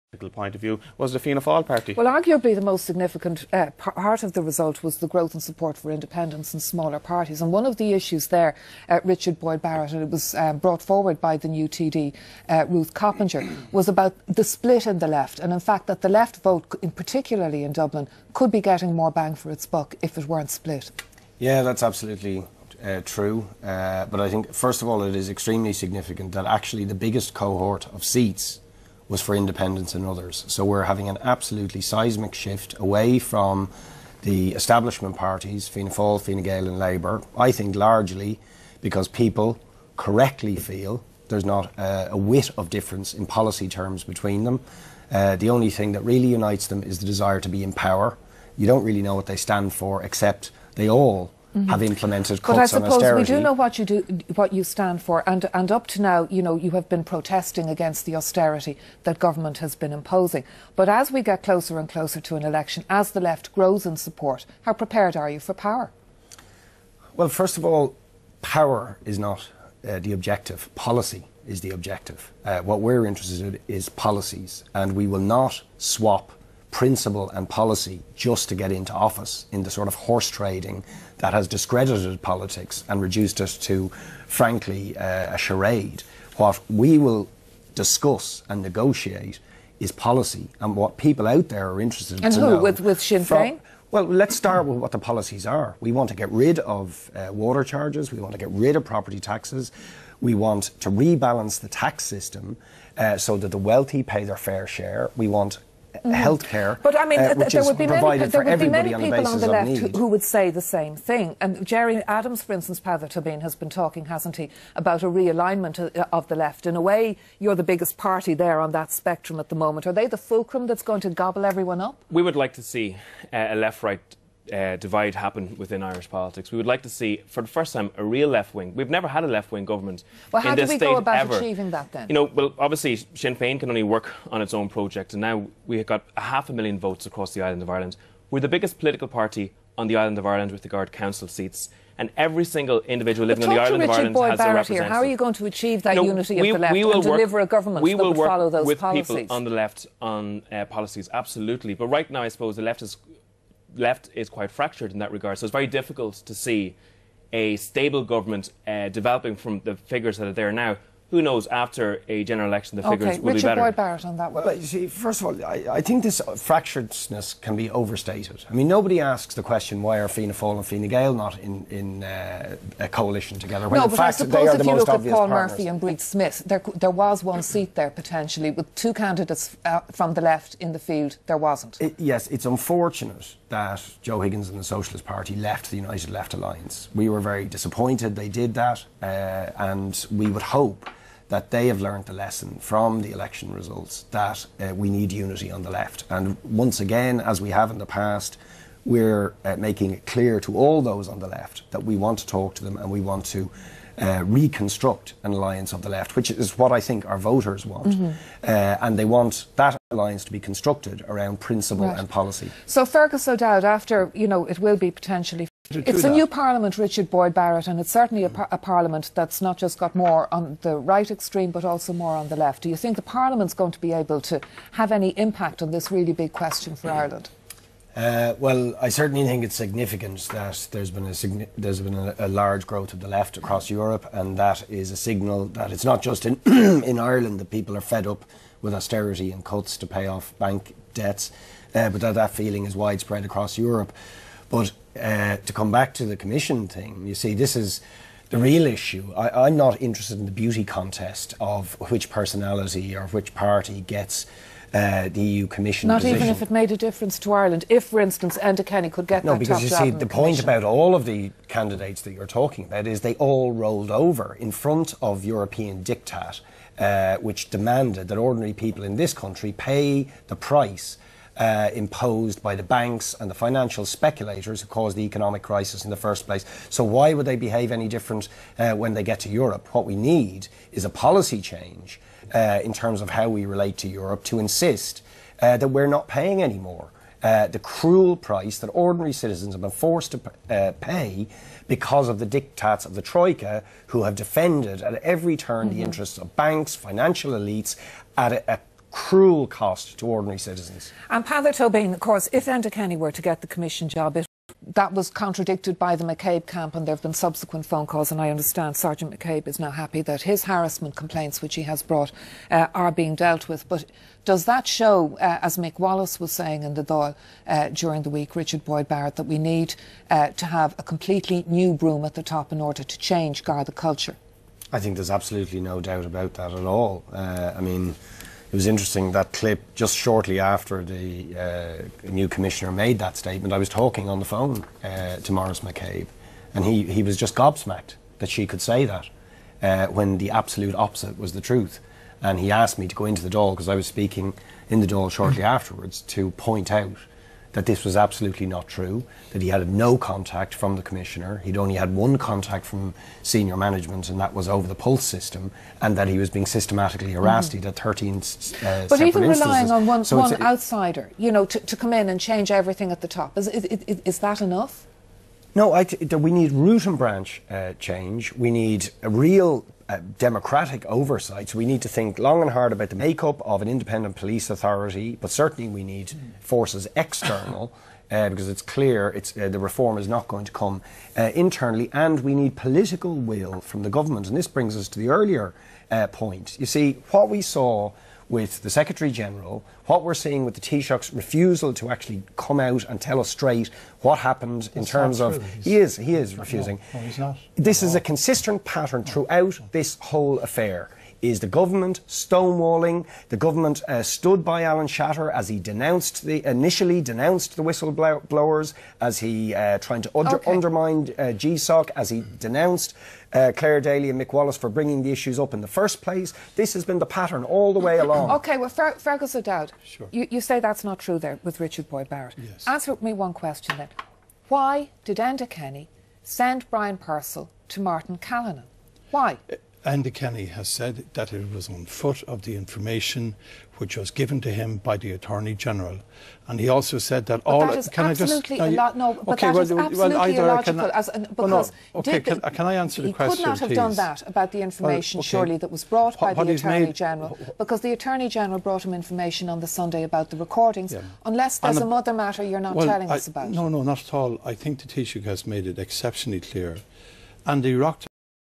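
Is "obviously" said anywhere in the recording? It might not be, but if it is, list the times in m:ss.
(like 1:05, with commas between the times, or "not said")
2:12.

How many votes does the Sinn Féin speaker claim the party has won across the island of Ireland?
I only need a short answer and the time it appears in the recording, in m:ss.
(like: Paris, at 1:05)
half a million, at 2:16.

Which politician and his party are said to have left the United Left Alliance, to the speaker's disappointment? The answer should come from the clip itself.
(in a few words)
Joe Higgins.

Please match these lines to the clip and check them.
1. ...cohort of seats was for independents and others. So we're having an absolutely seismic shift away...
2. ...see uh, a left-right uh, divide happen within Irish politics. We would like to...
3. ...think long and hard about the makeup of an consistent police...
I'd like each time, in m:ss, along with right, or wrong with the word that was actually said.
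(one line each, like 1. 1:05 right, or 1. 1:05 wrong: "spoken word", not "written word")
1. 0:27 right
2. 2:02 right
3. 6:11 wrong: "independent", not "consistent".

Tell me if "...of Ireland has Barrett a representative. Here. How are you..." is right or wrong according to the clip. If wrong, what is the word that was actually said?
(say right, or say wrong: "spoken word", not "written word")
right.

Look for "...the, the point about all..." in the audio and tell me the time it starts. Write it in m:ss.
4:19.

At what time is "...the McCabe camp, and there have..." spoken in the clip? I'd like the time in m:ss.
5:05.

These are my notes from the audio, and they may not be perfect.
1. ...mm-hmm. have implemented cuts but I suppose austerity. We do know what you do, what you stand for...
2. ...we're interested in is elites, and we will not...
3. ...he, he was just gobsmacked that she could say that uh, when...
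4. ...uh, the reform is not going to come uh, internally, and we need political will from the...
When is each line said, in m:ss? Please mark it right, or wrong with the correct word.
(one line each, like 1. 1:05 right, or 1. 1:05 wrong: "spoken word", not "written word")
1. 0:51 right
2. 1:12 wrong: "policies", not "elites"
3. 5:36 right
4. 6:19 right.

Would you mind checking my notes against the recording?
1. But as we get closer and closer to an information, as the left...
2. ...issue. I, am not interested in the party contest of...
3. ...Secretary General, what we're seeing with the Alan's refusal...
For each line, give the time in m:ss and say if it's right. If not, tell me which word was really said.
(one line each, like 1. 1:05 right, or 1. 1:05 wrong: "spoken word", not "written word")
1. 1:00 wrong: "election", not "information"
2. 4:08 wrong: "beauty", not "party"
3. 6:28 wrong: "Taoiseach", not "Alan".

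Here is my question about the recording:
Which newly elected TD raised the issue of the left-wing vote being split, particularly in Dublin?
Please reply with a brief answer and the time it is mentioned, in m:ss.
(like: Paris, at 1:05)
Ruth Coppinger, at 0:12.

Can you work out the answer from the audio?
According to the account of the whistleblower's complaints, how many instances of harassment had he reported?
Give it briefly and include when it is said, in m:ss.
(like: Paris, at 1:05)
13, at 5:57.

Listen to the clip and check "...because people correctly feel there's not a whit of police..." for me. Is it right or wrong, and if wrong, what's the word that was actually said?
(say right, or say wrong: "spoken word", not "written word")
wrong: "difference", not "police".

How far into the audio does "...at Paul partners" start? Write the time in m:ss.
2:54.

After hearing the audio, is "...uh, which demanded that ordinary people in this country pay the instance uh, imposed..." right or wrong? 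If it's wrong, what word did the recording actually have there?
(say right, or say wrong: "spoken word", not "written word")
wrong: "price", not "instance".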